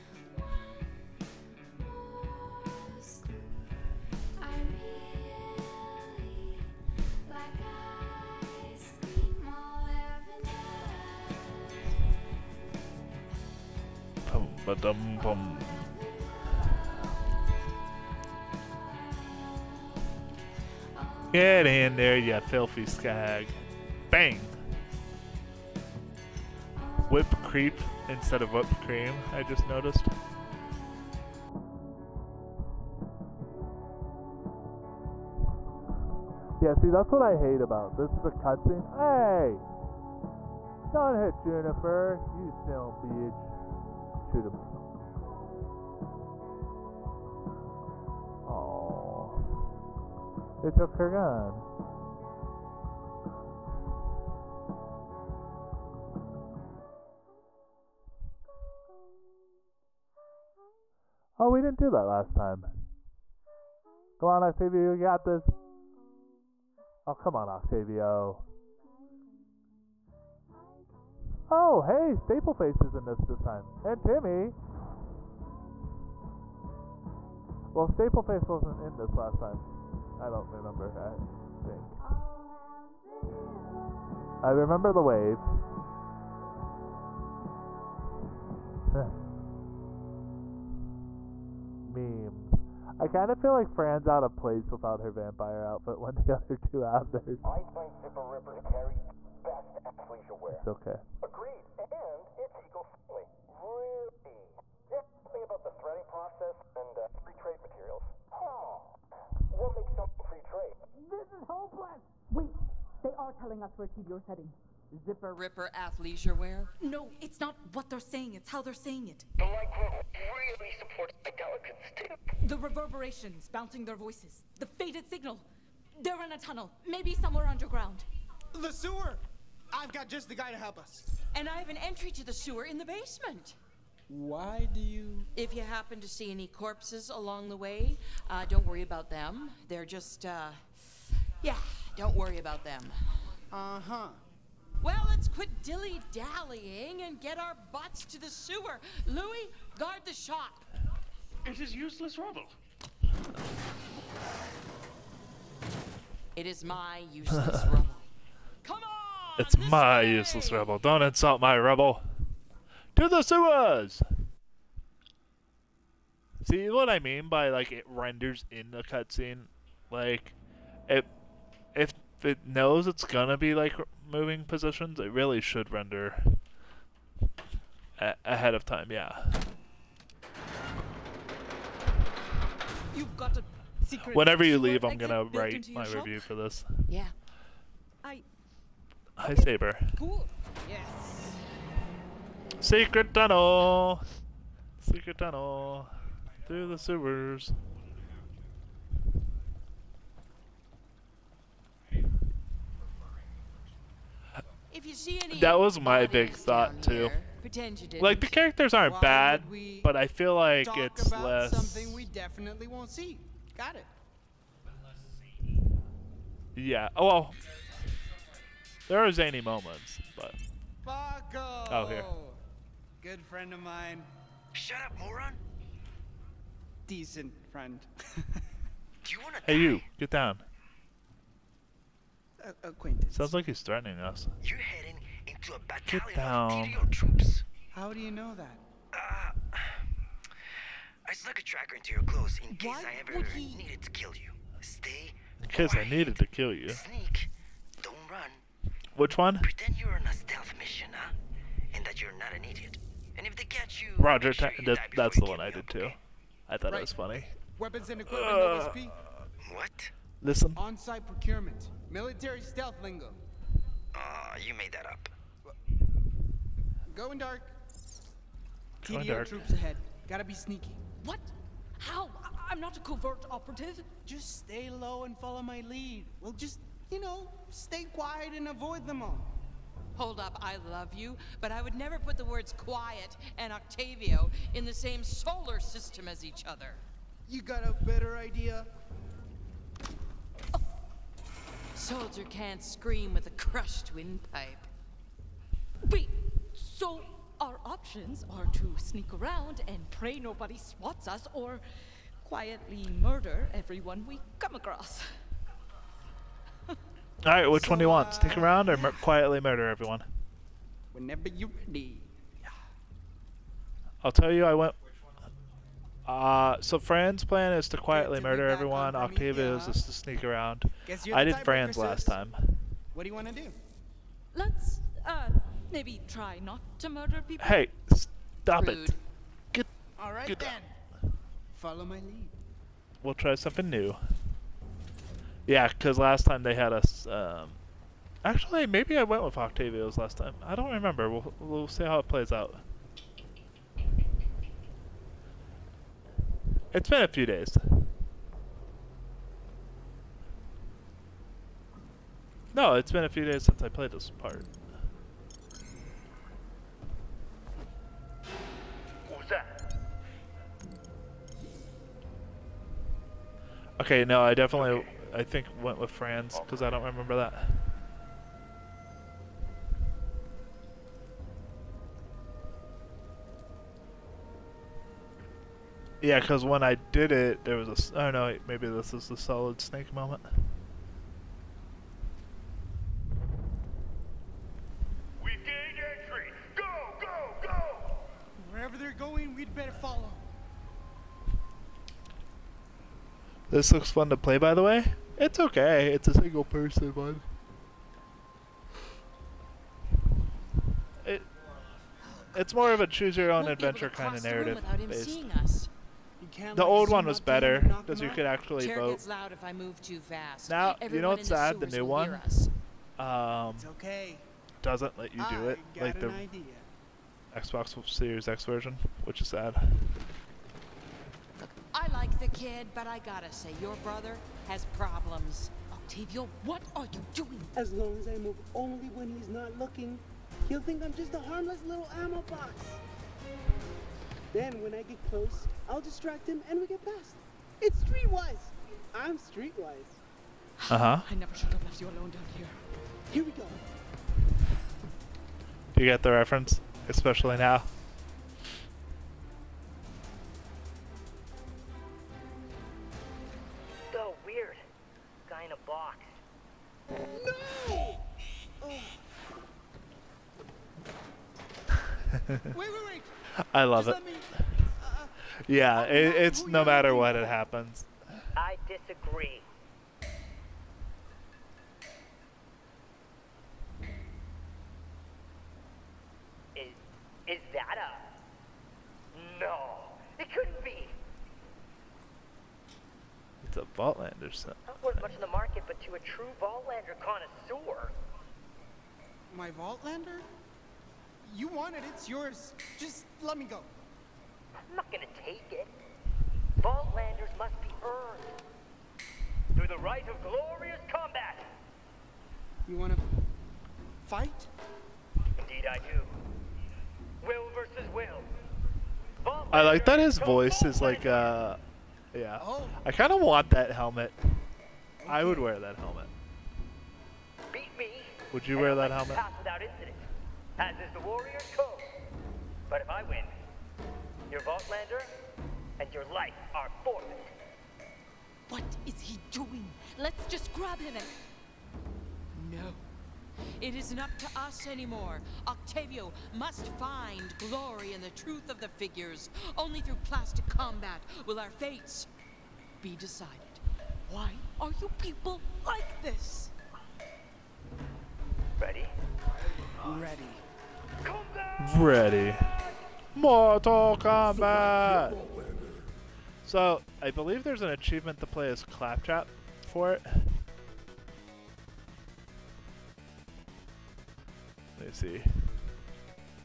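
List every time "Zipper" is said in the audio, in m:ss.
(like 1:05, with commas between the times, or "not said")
1:38, 1:54.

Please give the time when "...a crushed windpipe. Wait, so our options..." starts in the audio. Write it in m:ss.
4:53.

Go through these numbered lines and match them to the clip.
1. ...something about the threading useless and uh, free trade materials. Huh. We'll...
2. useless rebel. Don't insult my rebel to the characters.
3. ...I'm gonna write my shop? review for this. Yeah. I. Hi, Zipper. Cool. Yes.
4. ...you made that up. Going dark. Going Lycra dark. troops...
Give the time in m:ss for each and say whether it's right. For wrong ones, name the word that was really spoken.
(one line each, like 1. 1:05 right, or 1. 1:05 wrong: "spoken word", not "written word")
1. 1:45 wrong: "process", not "useless"
2. 2:40 wrong: "sewers", not "characters"
3. 3:04 wrong: "Saber", not "Zipper"
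4. 4:24 wrong: "TDO", not "Lycra".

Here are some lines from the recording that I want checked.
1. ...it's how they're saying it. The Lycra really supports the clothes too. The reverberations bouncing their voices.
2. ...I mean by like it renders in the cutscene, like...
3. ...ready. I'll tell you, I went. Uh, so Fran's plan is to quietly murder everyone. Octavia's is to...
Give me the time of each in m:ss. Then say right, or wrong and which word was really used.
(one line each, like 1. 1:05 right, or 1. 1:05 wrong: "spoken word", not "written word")
1. 1:58 wrong: "delicates", not "clothes"
2. 2:46 right
3. 5:11 right.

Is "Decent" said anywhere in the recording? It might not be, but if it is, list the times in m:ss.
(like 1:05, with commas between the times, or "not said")
3:46.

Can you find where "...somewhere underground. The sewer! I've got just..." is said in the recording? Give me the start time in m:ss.
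2:07.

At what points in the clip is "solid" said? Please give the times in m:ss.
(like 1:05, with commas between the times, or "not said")
6:19.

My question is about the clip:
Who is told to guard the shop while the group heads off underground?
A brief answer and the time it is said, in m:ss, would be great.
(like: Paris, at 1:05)
Louis, at 2:29.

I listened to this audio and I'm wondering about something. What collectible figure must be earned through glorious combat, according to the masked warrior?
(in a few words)
Vaultlander.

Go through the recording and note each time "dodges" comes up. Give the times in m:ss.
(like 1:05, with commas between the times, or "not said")
not said.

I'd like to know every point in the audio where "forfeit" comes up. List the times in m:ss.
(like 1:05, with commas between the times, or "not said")
8:46.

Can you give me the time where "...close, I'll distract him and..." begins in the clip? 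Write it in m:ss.
7:15.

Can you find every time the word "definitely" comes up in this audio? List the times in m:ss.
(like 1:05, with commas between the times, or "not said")
3:32, 6:04.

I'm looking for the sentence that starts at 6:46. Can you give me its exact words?
The old one was better because you could actually vote.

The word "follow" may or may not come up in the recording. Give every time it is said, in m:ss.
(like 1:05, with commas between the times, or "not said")
4:35, 5:31, 6:29.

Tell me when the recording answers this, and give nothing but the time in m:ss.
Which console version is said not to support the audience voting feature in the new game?
6:57.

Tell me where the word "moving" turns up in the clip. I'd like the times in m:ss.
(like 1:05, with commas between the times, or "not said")
2:54.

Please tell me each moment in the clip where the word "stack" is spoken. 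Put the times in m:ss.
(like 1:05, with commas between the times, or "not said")
not said.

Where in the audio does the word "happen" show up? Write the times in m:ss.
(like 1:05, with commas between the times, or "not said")
2:15, 7:47.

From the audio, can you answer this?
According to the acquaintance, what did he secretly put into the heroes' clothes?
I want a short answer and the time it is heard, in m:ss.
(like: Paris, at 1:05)
A tracker, at 4:01.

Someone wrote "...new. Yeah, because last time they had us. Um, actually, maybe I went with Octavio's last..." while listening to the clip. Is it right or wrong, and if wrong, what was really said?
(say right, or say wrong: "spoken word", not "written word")
right.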